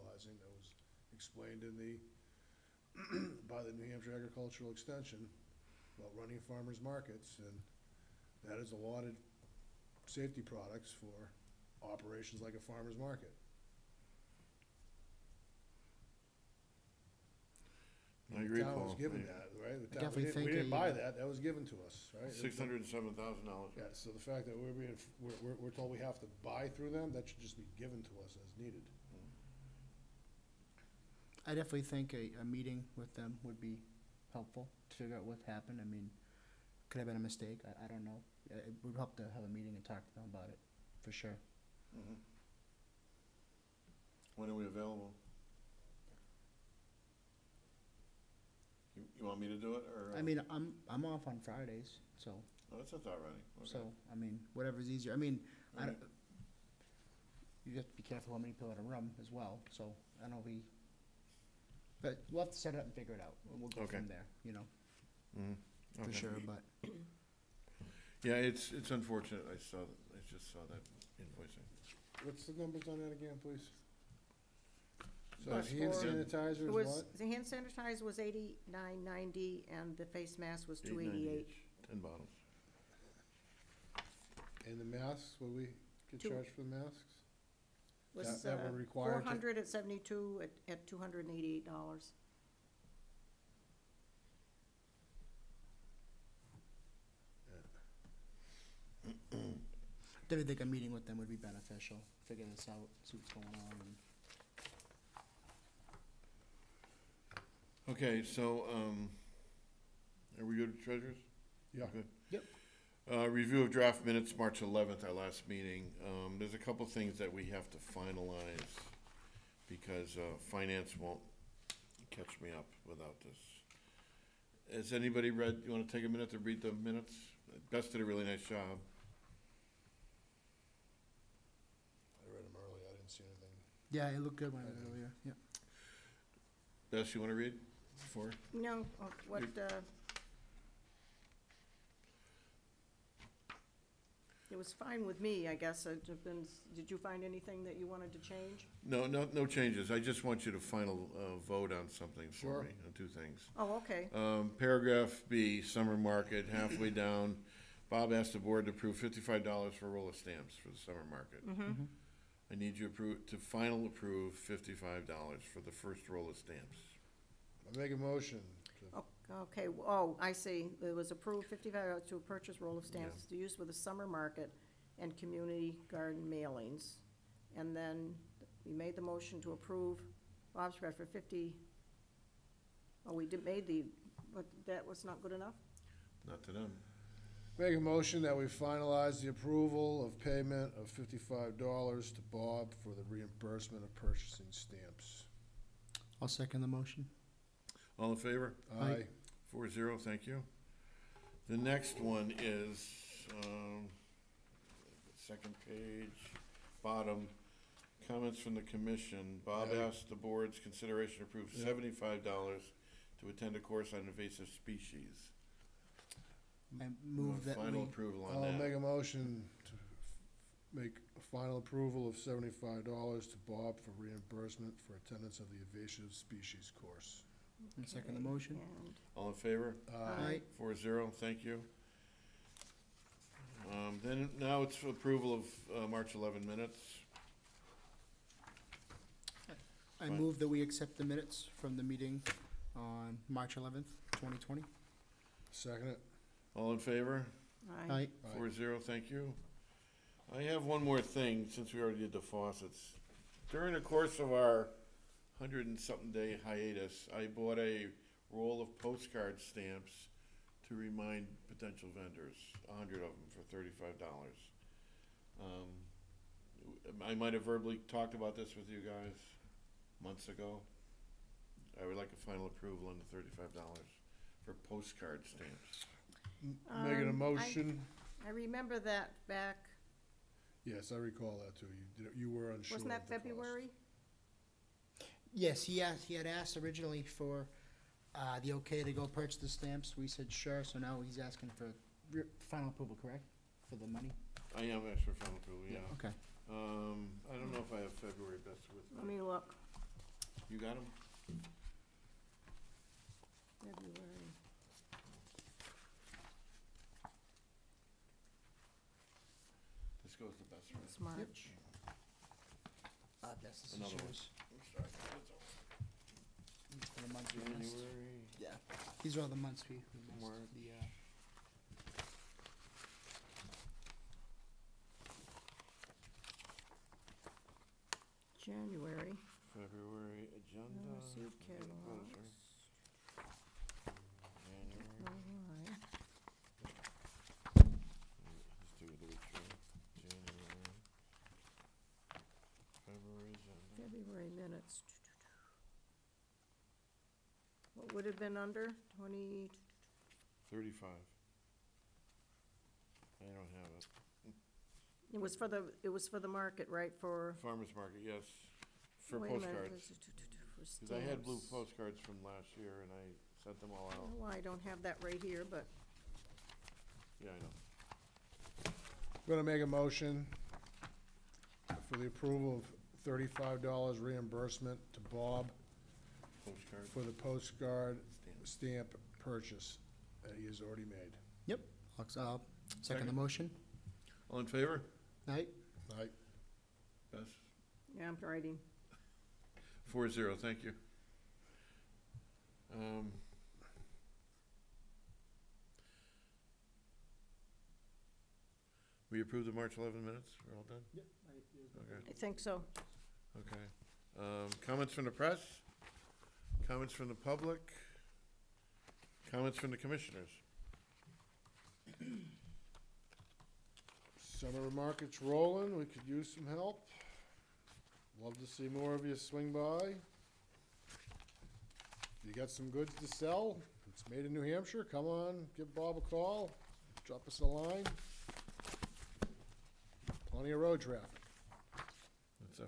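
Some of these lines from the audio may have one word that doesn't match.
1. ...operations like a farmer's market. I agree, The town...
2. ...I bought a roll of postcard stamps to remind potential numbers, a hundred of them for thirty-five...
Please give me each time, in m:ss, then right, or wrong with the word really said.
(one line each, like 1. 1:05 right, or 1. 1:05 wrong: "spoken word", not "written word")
1. 0:11 right
2. 4:17 wrong: "vendors", not "numbers".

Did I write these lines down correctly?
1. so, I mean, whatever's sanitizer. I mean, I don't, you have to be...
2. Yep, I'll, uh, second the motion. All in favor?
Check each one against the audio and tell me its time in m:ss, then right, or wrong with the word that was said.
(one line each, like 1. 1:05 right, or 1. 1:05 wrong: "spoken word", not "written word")
1. 0:53 wrong: "easier", not "sanitizer"
2. 6:21 right.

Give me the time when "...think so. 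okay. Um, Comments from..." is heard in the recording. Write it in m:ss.
6:42.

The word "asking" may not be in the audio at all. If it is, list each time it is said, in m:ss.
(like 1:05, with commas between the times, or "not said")
4:51.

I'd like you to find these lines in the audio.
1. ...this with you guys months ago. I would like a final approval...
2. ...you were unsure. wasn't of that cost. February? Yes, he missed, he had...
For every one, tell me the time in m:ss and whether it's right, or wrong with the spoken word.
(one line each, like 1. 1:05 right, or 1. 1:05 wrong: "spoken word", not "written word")
1. 4:28 right
2. 4:42 wrong: "asked", not "missed".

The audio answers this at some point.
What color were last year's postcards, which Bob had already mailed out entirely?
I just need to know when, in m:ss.
6:01.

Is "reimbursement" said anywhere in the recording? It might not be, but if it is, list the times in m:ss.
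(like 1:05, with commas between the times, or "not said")
3:13, 3:43, 6:13.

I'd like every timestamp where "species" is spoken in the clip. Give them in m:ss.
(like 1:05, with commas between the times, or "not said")
3:34, 3:46.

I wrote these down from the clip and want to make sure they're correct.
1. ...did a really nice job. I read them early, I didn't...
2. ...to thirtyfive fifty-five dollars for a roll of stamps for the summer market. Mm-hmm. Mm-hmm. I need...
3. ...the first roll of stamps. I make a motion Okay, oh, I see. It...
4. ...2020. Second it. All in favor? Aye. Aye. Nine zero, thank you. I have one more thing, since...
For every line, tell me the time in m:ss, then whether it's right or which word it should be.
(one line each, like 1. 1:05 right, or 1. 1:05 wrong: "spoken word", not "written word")
1. 2:07 right
2. 2:38 wrong: "approve", not "thirtyfive"
3. 2:45 right
4. 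4:04 wrong: "Four", not "Nine".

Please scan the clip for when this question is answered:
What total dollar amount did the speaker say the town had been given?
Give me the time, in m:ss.
0:22.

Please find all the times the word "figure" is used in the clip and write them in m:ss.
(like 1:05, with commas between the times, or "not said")
0:34, 1:02, 1:42.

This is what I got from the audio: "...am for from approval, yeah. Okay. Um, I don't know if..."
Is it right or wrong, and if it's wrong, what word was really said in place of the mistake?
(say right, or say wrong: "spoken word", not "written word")
right.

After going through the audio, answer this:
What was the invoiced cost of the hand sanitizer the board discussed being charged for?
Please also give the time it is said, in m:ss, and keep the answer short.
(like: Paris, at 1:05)
$89.90, at 1:18.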